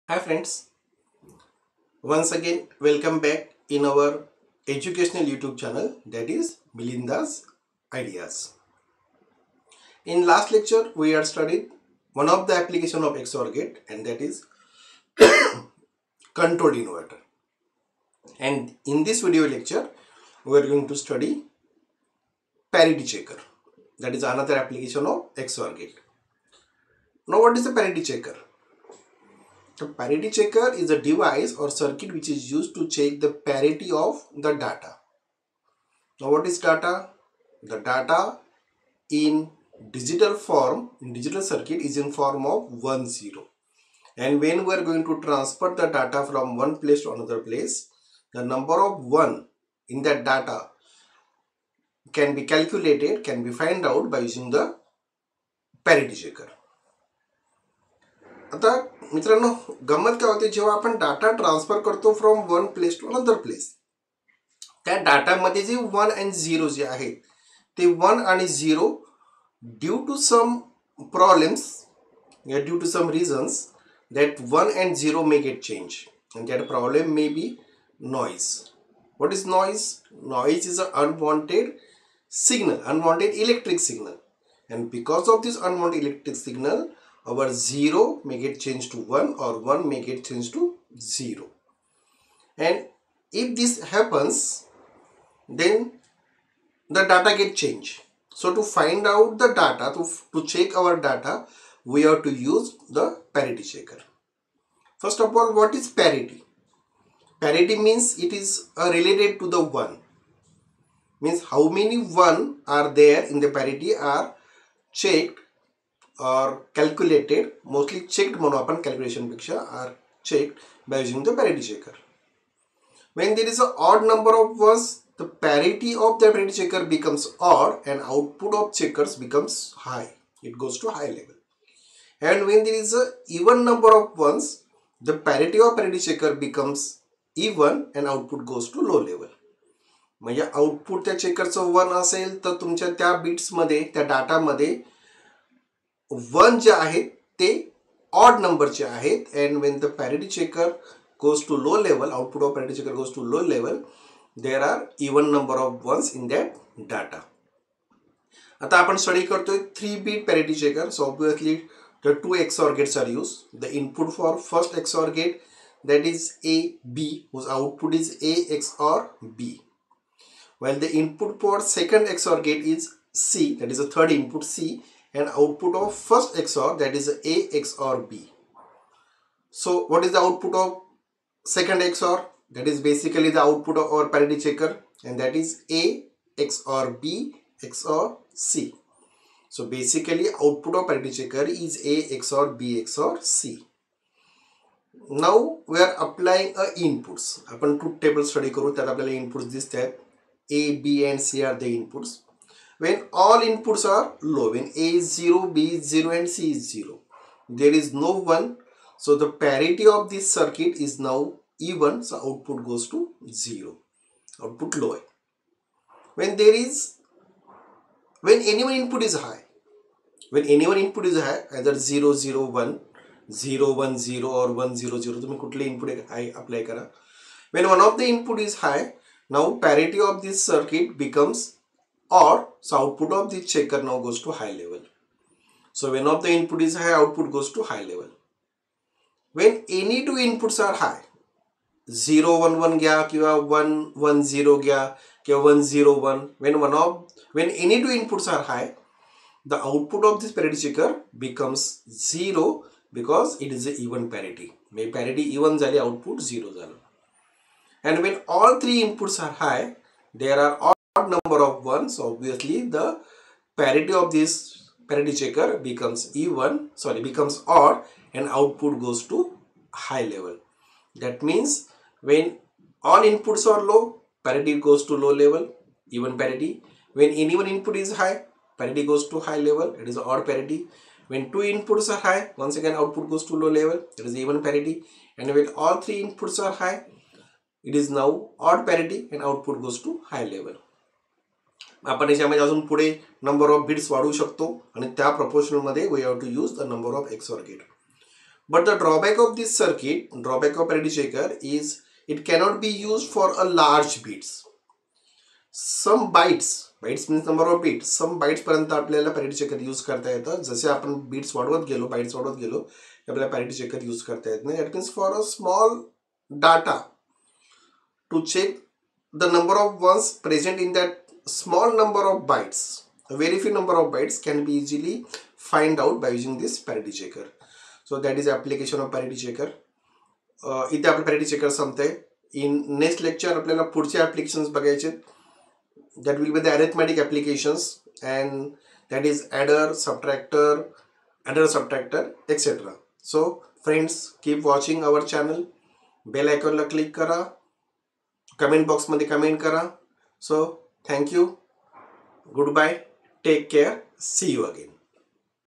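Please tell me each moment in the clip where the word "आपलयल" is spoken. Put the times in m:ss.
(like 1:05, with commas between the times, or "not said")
3:18, 5:33.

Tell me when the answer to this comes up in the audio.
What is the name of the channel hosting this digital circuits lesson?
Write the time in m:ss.
0:06.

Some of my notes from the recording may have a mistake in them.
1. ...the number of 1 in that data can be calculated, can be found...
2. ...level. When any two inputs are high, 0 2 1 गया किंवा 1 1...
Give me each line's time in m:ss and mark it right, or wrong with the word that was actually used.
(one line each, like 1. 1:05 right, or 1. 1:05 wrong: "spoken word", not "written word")
1. 0:48 right
2. 3:57 wrong: "1", not "2".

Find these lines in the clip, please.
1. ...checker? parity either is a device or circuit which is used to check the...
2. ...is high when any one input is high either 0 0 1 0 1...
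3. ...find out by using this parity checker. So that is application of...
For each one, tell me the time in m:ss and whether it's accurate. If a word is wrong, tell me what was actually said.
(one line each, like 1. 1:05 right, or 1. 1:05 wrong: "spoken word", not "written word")
1. 0:28 wrong: "checker", not "either"
2. 3:39 right
3. 5:25 right.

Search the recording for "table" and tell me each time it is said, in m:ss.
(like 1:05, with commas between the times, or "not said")
3:17.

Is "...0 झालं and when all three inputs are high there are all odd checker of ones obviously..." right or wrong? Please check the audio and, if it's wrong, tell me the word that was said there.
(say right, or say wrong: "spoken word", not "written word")
wrong: "number", not "checker".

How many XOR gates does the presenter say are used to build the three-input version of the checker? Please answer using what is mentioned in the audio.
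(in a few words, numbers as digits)
2.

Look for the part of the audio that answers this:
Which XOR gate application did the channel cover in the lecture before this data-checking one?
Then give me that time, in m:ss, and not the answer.
0:16.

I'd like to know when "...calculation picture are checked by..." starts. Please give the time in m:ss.
1:58.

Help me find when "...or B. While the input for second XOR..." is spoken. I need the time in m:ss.
2:48.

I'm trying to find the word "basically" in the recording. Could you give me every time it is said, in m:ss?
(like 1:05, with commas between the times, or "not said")
3:02, 3:09.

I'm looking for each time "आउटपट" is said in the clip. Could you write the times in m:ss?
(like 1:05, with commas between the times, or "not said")
2:20, 2:32.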